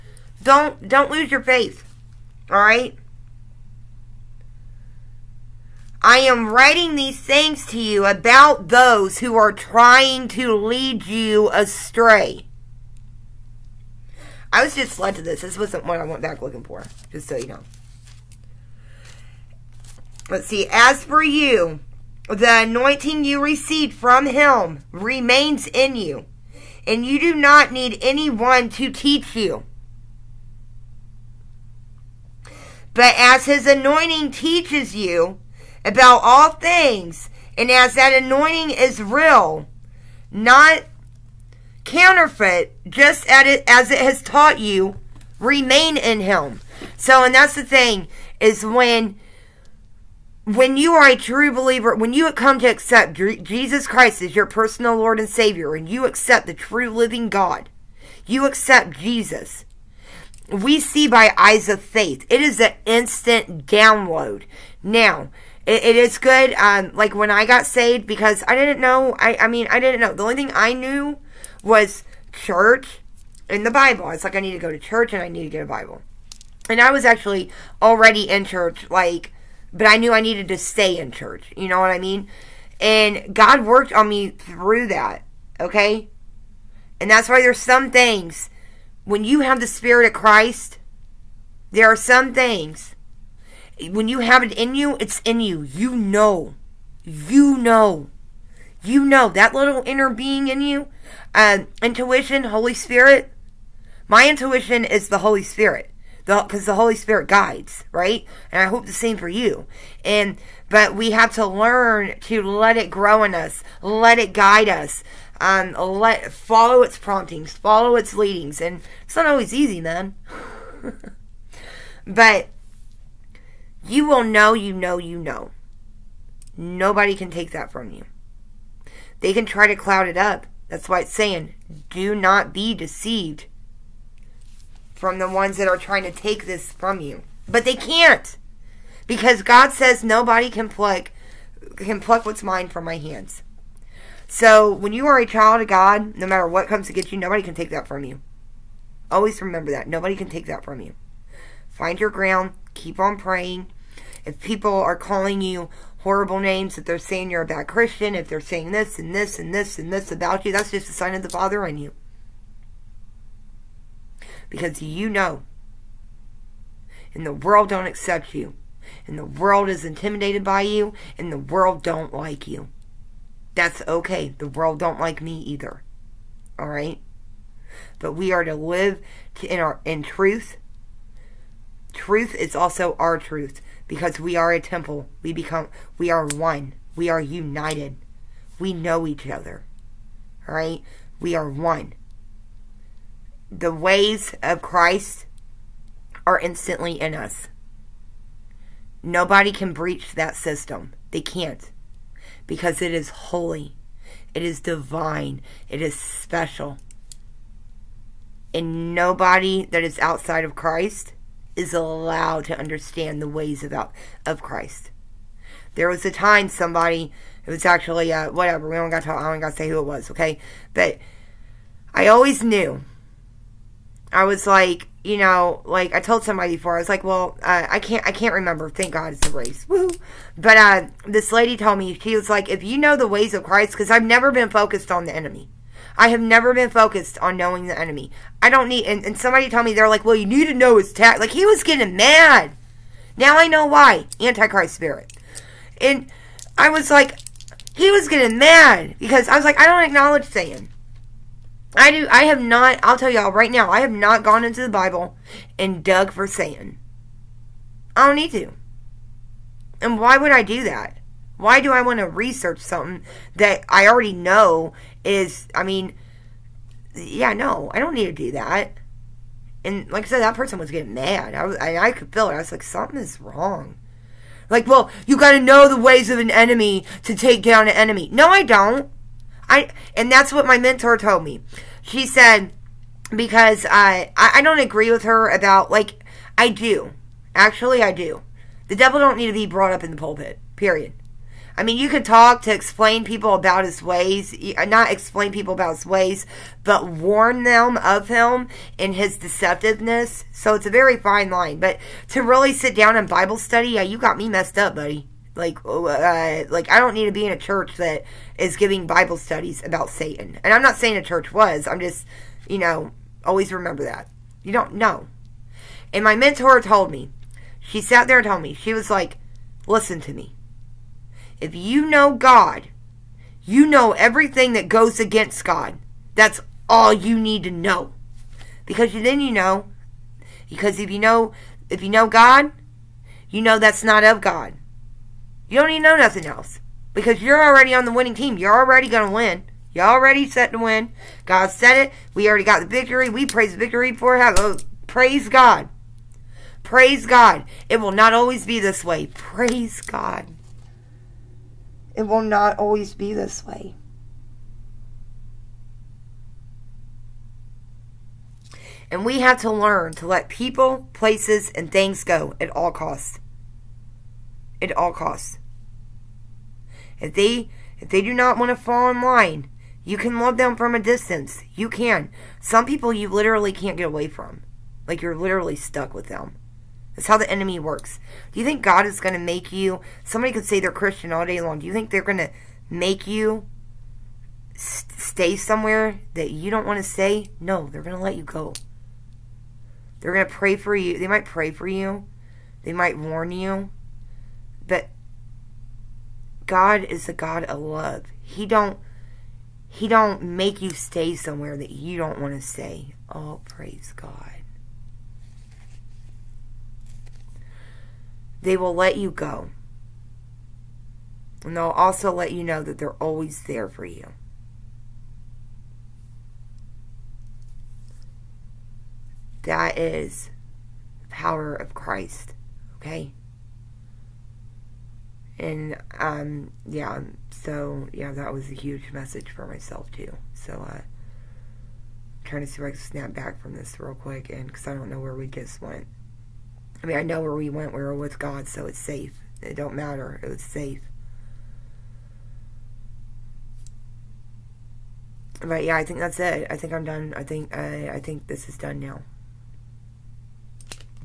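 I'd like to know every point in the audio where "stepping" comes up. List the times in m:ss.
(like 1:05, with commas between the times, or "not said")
not said.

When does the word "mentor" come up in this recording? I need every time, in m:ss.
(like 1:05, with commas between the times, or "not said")
4:40, 5:16.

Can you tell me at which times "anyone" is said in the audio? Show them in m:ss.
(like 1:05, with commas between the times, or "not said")
0:28.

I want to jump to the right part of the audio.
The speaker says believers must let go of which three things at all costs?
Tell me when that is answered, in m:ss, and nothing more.
6:00.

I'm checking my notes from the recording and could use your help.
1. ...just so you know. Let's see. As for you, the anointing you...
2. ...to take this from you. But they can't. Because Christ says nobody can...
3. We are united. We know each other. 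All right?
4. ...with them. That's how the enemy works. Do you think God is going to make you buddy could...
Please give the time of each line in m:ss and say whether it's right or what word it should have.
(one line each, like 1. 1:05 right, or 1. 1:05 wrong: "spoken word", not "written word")
1. 0:17 right
2. 2:16 wrong: "God", not "Christ"
3. 3:06 right
4. 6:15 wrong: "somebody", not "buddy".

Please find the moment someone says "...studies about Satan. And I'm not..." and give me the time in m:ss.
5:09.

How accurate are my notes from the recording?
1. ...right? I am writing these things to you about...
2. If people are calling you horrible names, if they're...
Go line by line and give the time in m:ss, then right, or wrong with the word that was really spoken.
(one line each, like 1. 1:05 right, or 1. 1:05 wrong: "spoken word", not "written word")
1. 0:02 right
2. 2:34 right.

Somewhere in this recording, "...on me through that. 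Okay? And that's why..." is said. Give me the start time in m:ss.
1:23.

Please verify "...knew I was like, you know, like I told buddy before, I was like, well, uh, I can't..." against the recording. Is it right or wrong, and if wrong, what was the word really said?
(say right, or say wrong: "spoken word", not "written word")
wrong: "somebody", not "buddy".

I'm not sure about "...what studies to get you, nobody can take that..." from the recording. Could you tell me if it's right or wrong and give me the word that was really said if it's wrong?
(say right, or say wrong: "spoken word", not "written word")
wrong: "comes", not "studies".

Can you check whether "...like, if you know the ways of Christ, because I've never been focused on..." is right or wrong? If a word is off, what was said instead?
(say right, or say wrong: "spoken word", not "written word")
right.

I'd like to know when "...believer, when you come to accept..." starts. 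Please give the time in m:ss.
0:51.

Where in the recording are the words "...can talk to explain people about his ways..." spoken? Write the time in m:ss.
4:51.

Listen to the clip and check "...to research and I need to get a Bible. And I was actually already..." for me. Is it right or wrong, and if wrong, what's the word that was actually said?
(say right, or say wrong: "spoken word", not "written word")
wrong: "church", not "research".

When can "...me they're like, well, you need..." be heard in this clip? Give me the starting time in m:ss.
3:59.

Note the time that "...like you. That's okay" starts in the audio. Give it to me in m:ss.
2:52.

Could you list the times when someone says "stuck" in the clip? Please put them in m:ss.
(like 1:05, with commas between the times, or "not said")
6:15.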